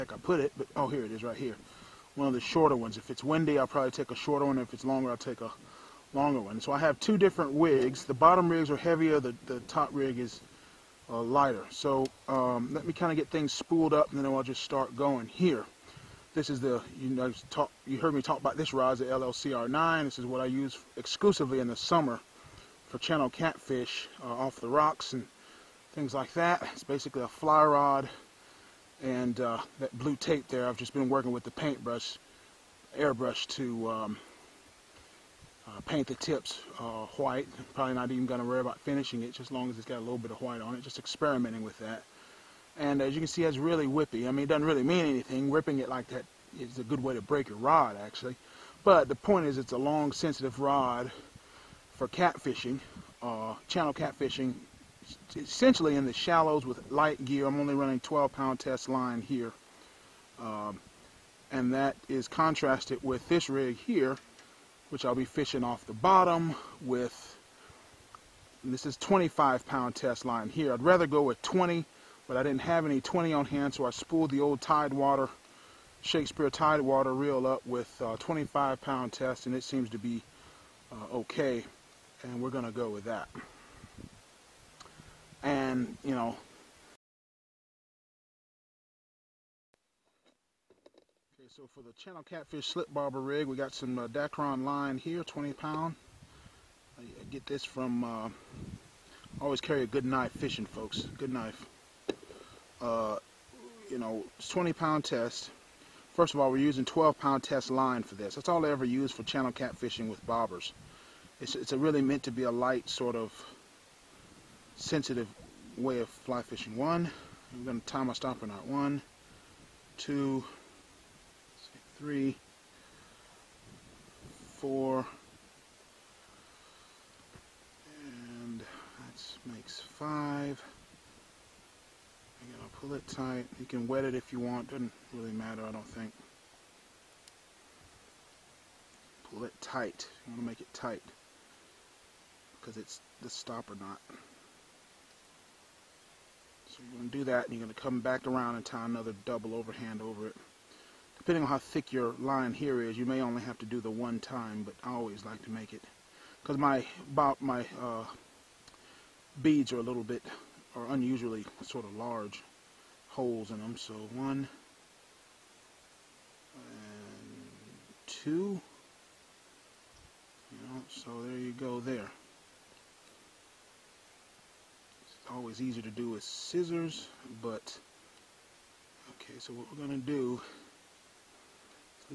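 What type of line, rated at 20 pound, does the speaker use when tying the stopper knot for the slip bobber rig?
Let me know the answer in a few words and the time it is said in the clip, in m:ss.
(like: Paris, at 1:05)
Dacron, at 1:34.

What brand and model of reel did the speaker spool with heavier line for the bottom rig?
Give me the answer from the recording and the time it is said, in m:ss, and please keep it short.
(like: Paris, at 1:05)
Shakespeare Tidewater, at 1:16.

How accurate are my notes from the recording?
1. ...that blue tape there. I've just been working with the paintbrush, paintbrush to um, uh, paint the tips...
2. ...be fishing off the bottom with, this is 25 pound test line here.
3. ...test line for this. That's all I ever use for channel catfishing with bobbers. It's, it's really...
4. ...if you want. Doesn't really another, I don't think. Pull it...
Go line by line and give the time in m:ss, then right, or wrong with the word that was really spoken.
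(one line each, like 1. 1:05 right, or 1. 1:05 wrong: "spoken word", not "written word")
1. 0:29 wrong: "airbrush", not "paintbrush"
2. 1:05 right
3. 1:47 right
4. 2:14 wrong: "matter", not "another".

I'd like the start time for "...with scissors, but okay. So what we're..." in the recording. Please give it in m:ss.
2:56.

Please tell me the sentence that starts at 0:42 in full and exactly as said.
And as you can see, it's really whippy.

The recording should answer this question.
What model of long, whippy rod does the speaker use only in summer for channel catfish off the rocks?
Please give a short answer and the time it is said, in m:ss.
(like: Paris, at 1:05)
LLCR9, at 0:19.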